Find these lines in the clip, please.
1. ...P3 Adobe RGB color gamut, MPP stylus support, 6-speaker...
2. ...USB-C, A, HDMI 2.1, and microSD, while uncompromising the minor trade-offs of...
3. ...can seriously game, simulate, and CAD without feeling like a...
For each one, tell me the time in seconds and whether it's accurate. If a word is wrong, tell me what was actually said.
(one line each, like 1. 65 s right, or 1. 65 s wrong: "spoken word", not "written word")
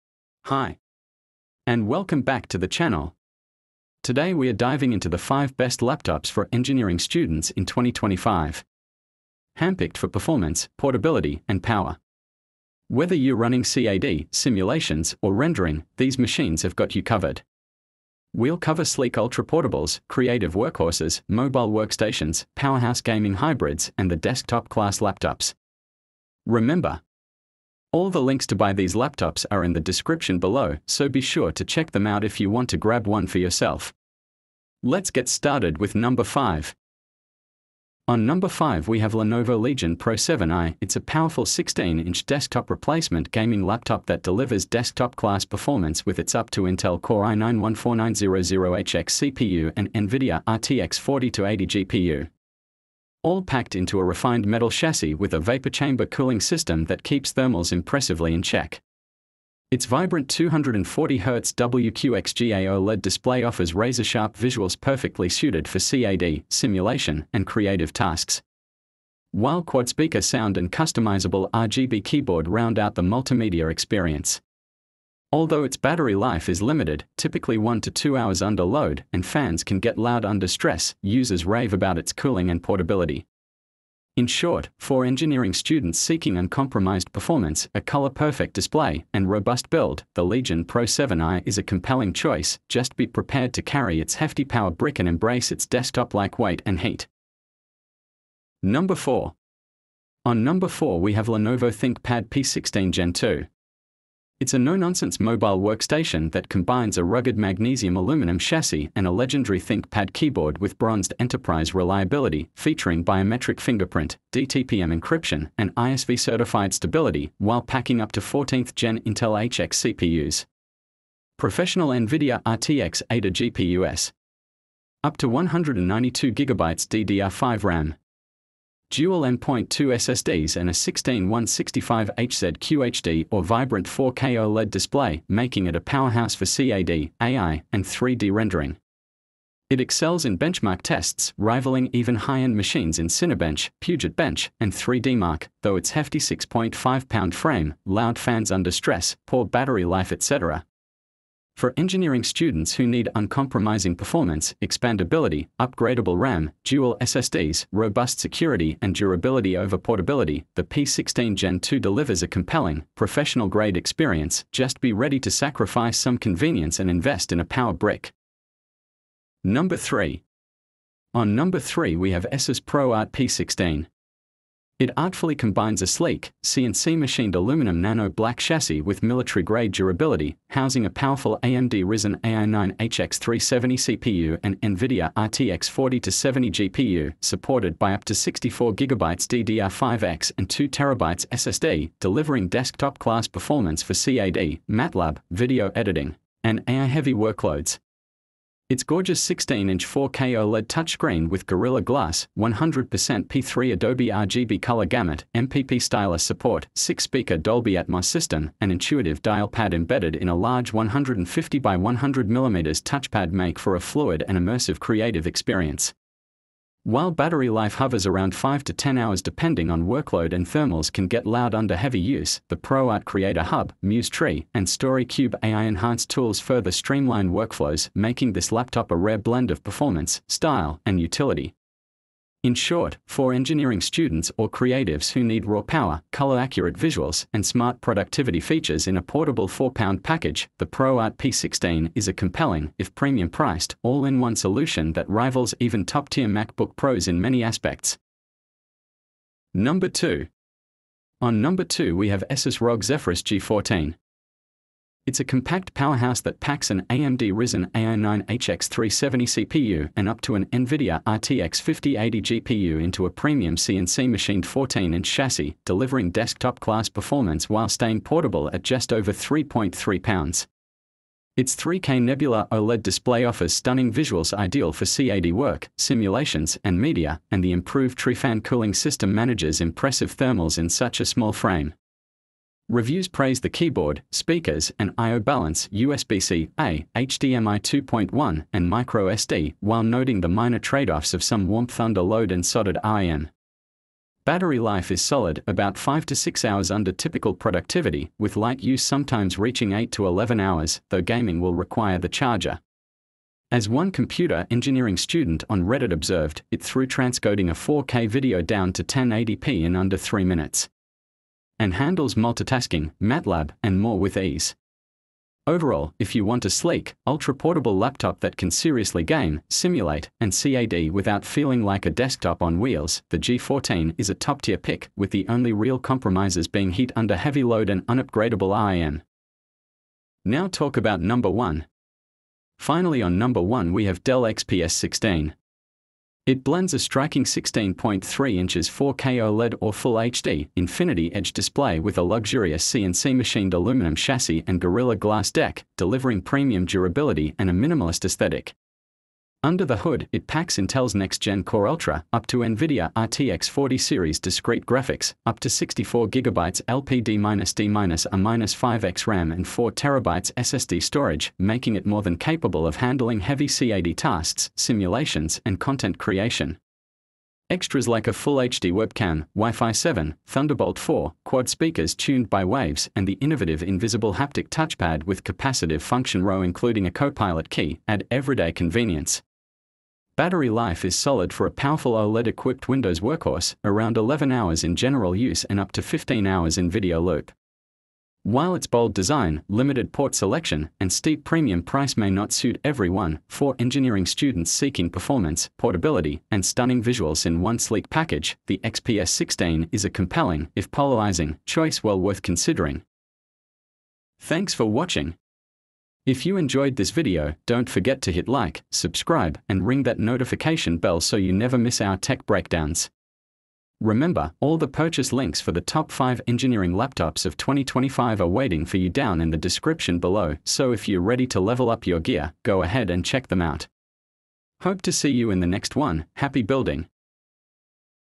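1. 203 s right
2. 285 s wrong: "noting", not "uncompromising"
3. 318 s right.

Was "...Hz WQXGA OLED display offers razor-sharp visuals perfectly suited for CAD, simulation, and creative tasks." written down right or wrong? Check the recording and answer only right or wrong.
right.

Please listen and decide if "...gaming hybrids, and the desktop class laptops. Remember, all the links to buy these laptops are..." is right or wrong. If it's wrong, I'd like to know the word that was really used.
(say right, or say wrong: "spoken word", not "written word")
right.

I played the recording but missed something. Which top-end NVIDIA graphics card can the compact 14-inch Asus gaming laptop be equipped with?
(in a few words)
RTX 5080.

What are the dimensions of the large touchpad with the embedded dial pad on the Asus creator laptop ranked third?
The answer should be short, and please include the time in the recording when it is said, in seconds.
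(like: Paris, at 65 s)
150 by 100 mm, at 210 s.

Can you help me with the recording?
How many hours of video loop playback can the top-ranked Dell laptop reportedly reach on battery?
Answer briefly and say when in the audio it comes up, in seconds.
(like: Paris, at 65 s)
15 hours, at 385 s.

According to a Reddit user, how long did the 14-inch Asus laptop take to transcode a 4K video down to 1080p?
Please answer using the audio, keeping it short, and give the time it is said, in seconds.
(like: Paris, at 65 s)
under 3 minutes, at 309 s.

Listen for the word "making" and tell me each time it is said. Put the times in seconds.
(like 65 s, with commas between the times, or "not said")
135 s, 227 s, 361 s.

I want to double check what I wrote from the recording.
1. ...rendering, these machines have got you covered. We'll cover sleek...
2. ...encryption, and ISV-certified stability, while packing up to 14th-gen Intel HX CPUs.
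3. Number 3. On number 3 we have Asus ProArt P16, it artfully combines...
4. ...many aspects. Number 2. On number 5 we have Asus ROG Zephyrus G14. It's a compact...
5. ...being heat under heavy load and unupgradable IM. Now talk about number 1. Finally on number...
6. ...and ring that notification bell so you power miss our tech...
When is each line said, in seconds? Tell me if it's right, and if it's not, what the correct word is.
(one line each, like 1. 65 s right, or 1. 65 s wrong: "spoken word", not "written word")
1. 15 s right
2. 114 s right
3. 169 s right
4. 247 s wrong: "2", not "5"
5. 326 s right
6. 409 s wrong: "never", not "power".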